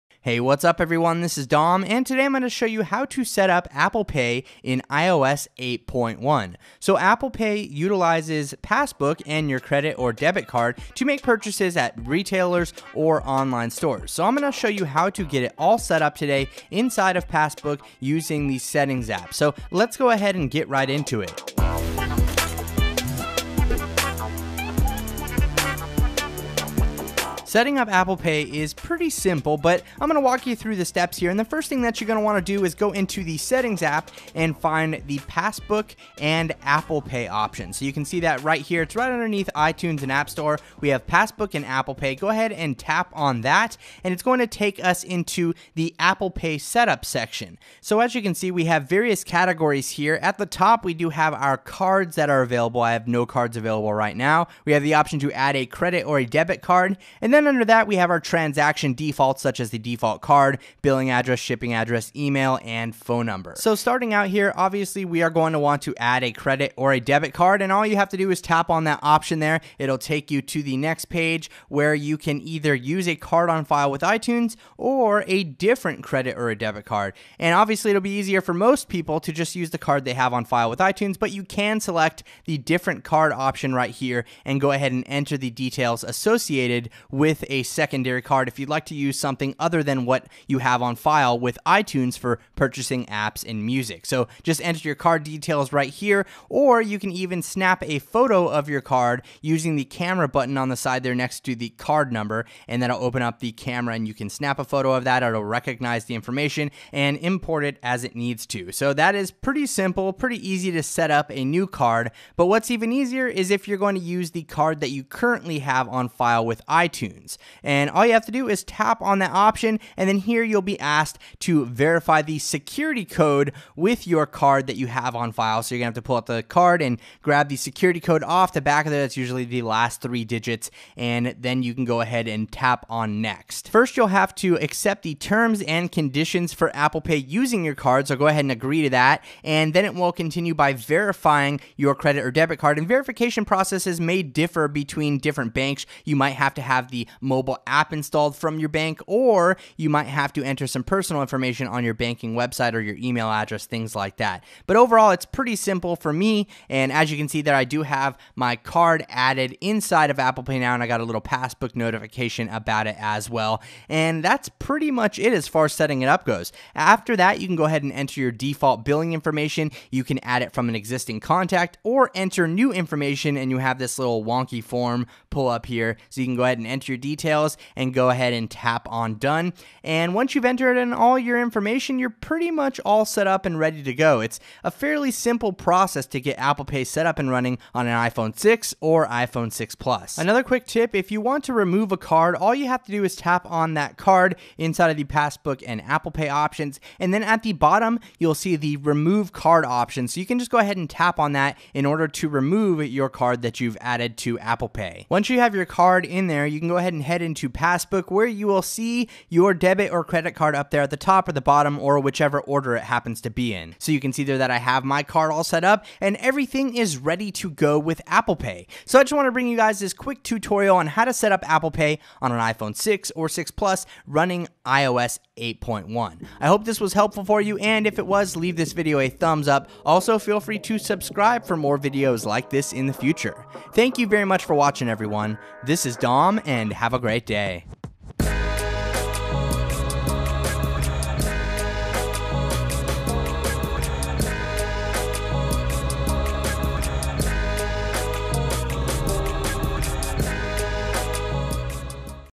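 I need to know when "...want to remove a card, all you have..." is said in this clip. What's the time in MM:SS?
03:11.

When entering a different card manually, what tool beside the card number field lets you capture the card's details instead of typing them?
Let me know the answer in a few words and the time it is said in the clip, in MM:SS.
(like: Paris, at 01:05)
camera button, at 01:39.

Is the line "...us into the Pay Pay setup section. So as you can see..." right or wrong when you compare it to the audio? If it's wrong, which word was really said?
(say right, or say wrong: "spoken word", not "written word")
wrong: "Apple", not "Pay".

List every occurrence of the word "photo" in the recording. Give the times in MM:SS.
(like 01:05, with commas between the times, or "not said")
01:37, 01:44.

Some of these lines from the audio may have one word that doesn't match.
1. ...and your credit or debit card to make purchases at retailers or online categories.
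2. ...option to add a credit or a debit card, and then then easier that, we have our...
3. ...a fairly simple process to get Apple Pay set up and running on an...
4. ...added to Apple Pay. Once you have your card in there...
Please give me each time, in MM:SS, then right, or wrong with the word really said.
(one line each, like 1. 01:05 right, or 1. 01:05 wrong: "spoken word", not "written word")
1. 00:09 wrong: "stores", not "categories"
2. 00:54 wrong: "under", not "easier"
3. 03:04 right
4. 03:23 right.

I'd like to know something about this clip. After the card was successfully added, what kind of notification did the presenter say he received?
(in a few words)
Passbook notification.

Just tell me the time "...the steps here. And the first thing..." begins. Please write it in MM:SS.
00:30.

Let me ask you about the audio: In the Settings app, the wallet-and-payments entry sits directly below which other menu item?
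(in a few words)
iTunes and App Store.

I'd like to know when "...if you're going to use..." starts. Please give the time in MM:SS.
01:53.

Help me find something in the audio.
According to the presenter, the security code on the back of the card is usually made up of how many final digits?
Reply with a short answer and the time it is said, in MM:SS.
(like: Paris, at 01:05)
3, at 02:10.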